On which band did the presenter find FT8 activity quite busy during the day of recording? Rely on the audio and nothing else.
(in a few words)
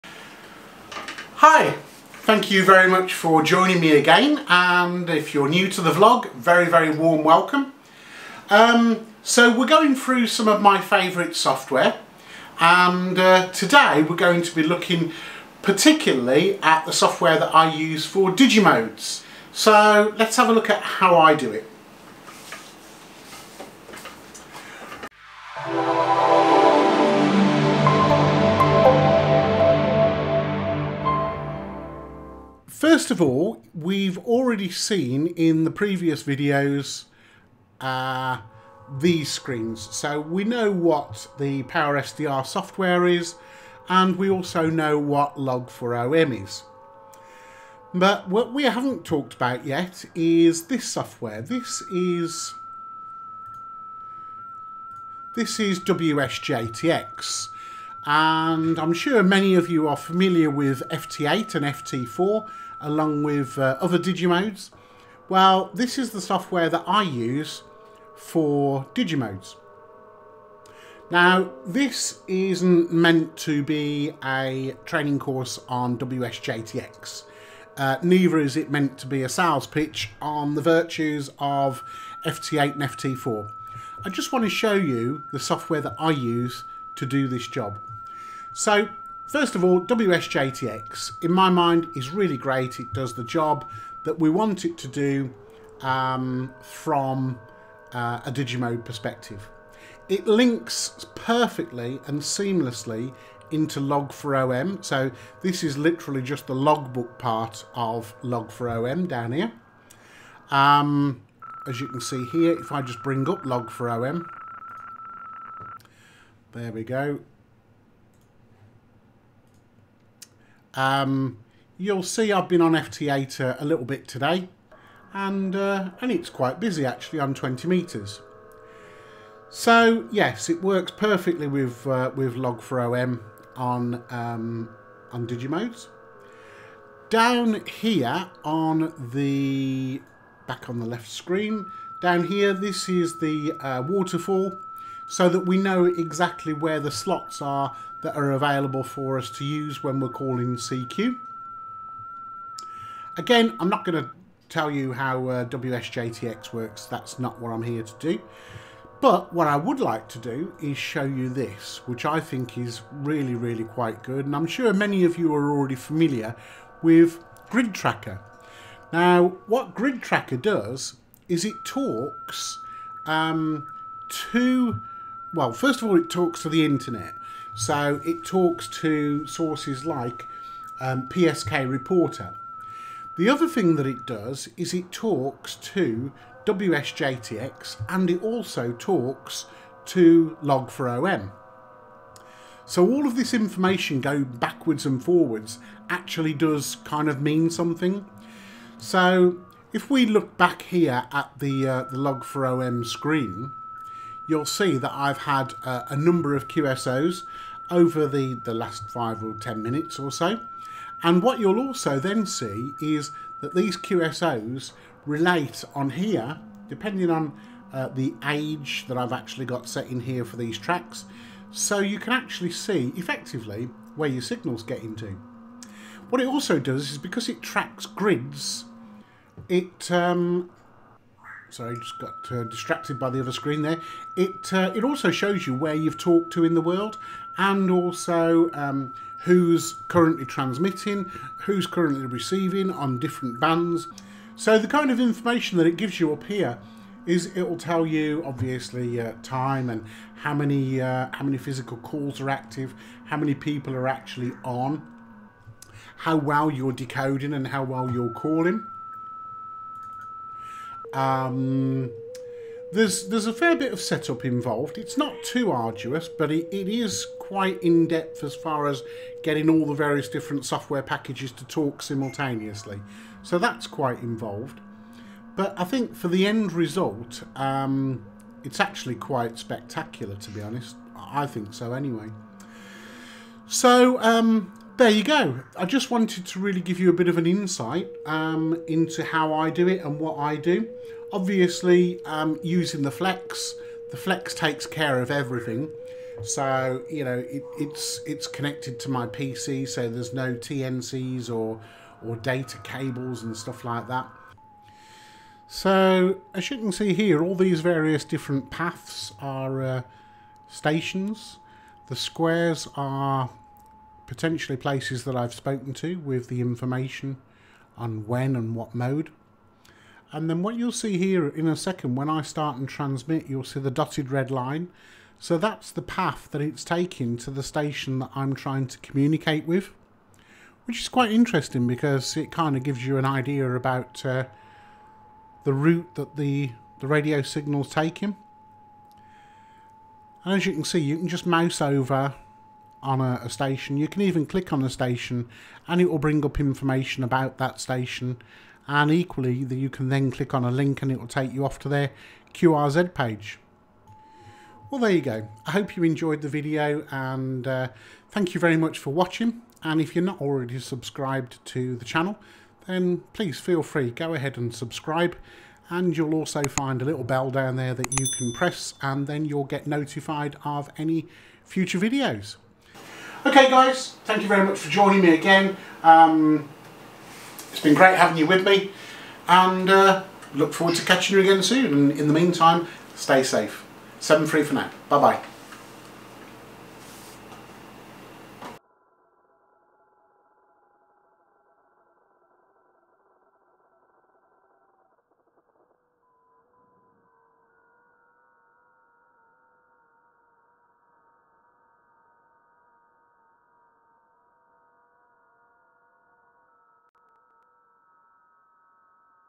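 20 metres.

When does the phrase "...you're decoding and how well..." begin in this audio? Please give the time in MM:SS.
04:16.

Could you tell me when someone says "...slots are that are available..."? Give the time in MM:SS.
02:26.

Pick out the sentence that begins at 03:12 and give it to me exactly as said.
So all of this information going backwards and forwards actually does kind of mean something.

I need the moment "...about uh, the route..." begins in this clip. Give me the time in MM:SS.
05:33.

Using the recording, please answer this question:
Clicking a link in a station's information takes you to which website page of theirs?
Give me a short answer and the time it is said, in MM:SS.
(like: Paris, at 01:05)
QRZ page, at 05:52.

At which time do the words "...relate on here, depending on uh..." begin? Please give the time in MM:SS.
03:35.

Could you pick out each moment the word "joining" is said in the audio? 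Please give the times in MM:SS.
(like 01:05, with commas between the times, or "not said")
00:03, 06:14.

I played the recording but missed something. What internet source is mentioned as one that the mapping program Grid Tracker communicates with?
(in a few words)
PSK Reporter.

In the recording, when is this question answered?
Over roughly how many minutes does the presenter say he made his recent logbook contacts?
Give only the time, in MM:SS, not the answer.
03:28.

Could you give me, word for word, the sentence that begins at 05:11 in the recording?
The squares are potentially places that I've spoken to with the information on when and what mode.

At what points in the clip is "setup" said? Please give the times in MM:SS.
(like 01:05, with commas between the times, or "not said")
04:23.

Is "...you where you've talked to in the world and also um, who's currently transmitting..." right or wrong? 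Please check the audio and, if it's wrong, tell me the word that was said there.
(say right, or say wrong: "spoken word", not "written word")
right.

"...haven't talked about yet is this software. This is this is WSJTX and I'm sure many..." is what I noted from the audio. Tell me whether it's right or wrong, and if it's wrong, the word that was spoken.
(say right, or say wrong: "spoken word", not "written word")
right.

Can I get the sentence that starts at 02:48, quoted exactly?
Now, what Grid Tracker does is it talks um, to well, first of all, it talks to the internet.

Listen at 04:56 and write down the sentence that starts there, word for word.
So, you know, it, it's it's connected to my PC, so there's no TNCs or, or data cables and stuff like that.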